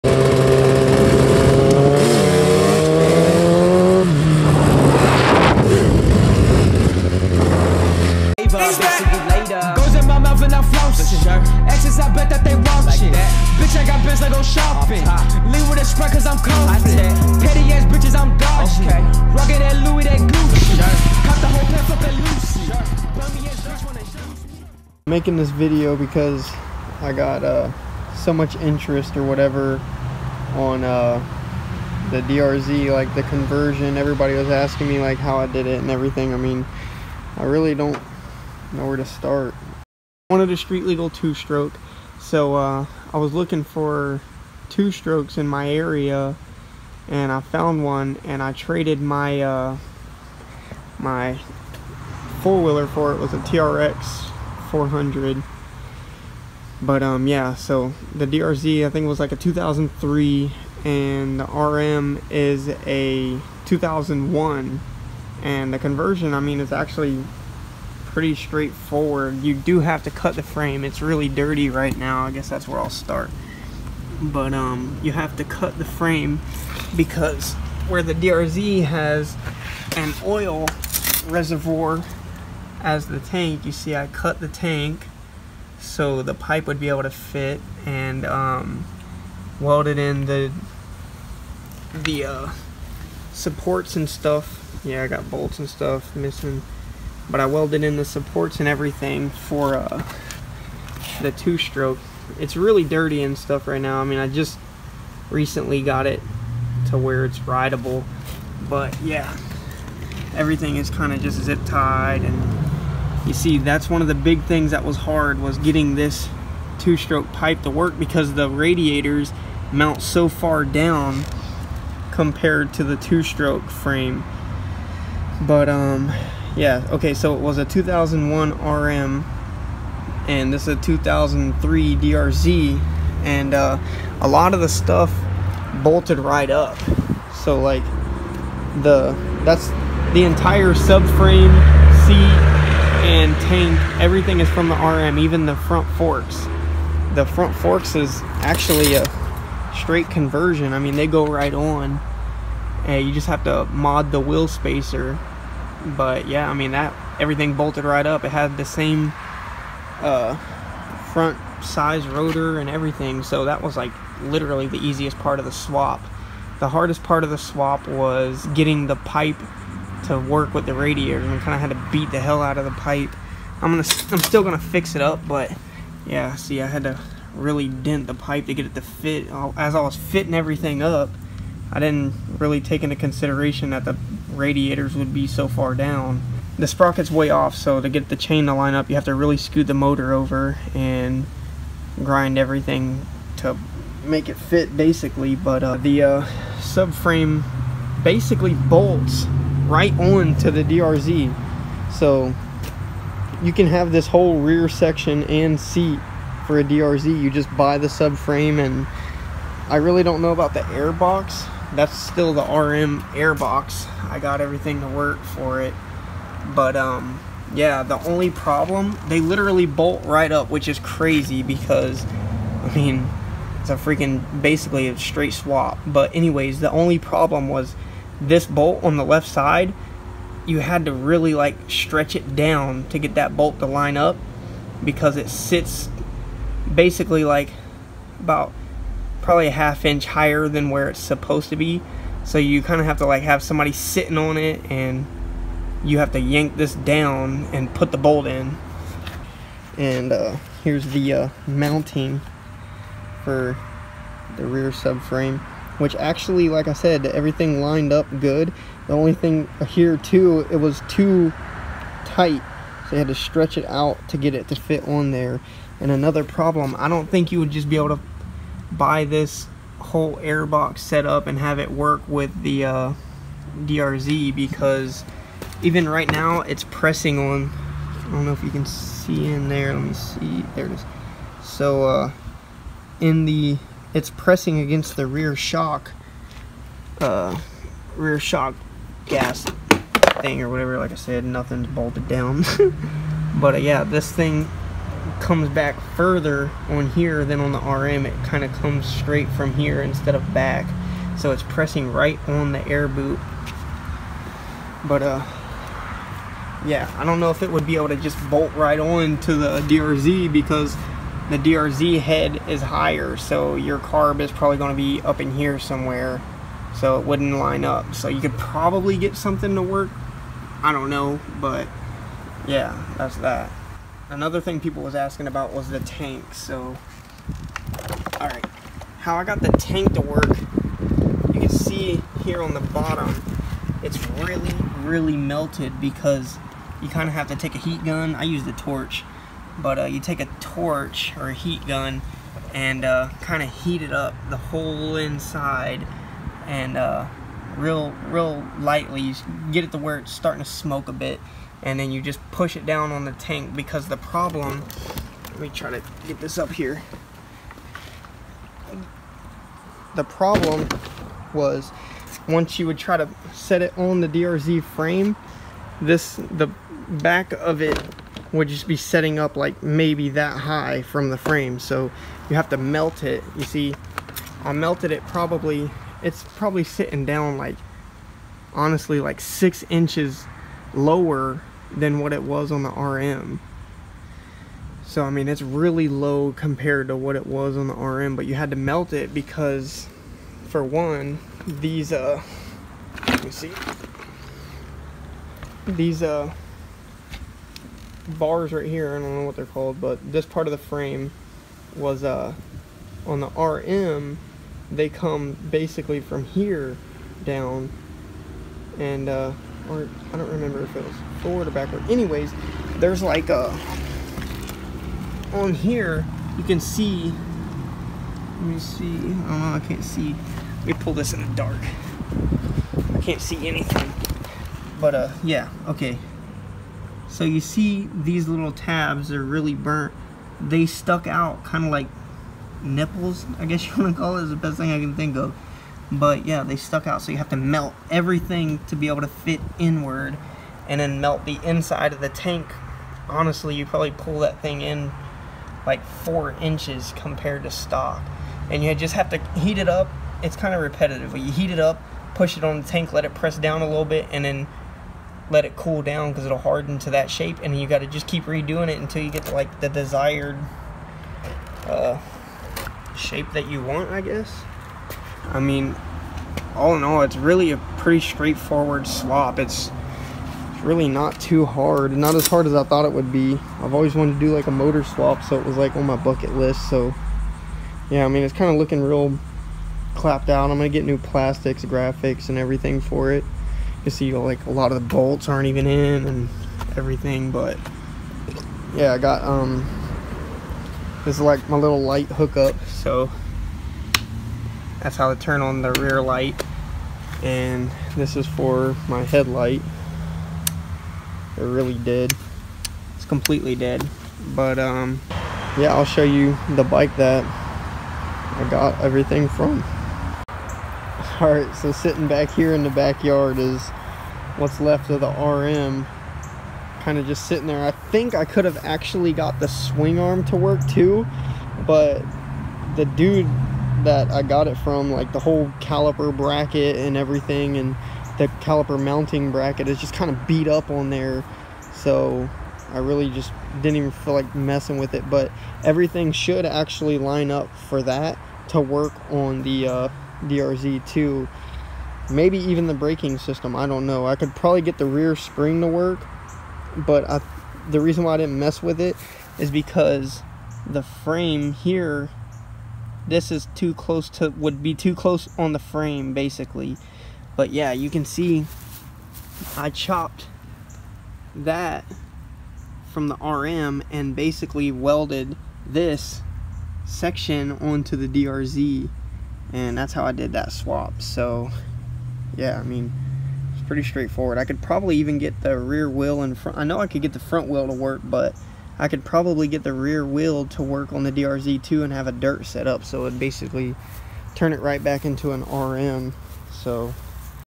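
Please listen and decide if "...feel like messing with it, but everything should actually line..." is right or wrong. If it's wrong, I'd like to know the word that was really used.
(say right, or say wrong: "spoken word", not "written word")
right.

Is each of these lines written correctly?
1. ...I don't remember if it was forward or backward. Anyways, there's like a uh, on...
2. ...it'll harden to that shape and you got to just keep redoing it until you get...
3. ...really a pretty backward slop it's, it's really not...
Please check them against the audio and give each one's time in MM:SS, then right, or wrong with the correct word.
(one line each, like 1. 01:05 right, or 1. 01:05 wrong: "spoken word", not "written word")
1. 06:50 right
2. 07:36 right
3. 07:47 wrong: "straightforward", not "backward".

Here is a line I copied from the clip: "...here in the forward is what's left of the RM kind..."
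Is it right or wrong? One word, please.
wrong.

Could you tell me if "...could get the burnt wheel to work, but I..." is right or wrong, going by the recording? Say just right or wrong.
wrong.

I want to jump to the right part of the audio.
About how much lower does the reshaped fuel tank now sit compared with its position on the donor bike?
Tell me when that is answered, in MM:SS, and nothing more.
06:19.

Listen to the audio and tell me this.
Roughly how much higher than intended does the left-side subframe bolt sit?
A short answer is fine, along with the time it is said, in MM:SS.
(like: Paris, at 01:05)
half inch, at 03:59.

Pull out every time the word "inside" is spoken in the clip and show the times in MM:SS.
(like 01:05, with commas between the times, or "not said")
05:44, 07:21.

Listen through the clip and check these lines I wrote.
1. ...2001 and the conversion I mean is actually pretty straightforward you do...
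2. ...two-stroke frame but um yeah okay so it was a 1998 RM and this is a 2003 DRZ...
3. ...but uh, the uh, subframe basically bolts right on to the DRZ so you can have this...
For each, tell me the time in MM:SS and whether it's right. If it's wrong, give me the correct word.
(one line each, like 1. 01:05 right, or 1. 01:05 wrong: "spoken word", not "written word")
1. 01:03 right
2. 02:02 wrong: "2001", not "1998"
3. 03:15 right.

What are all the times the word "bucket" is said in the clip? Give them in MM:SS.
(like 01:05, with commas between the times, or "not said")
07:55.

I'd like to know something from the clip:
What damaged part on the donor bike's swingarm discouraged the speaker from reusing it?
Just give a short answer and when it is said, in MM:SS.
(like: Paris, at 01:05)
caliper bracket, at 08:45.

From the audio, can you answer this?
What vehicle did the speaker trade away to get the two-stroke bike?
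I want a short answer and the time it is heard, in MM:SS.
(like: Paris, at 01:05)
TRX 400, at 00:53.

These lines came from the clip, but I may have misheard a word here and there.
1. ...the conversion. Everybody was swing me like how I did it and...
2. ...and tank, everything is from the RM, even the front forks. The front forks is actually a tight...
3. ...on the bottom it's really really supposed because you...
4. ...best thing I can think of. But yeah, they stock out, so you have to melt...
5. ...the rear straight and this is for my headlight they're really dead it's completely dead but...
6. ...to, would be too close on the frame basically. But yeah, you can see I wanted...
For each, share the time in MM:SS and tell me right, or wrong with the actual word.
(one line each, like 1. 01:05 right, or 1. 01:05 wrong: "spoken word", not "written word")
1. 00:33 wrong: "asking", not "swing"
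2. 02:23 wrong: "straight", not "tight"
3. 05:32 wrong: "melted", not "supposed"
4. 07:14 wrong: "stuck", not "stock"
5. 08:15 wrong: "light", not "straight"
6. 09:14 wrong: "chopped", not "wanted".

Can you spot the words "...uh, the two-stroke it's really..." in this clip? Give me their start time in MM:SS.
01:39.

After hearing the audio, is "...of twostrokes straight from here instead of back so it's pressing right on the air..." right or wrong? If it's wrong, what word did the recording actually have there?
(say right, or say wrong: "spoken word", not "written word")
wrong: "comes", not "twostrokes".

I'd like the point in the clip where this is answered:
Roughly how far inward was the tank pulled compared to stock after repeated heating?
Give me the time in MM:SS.
07:25.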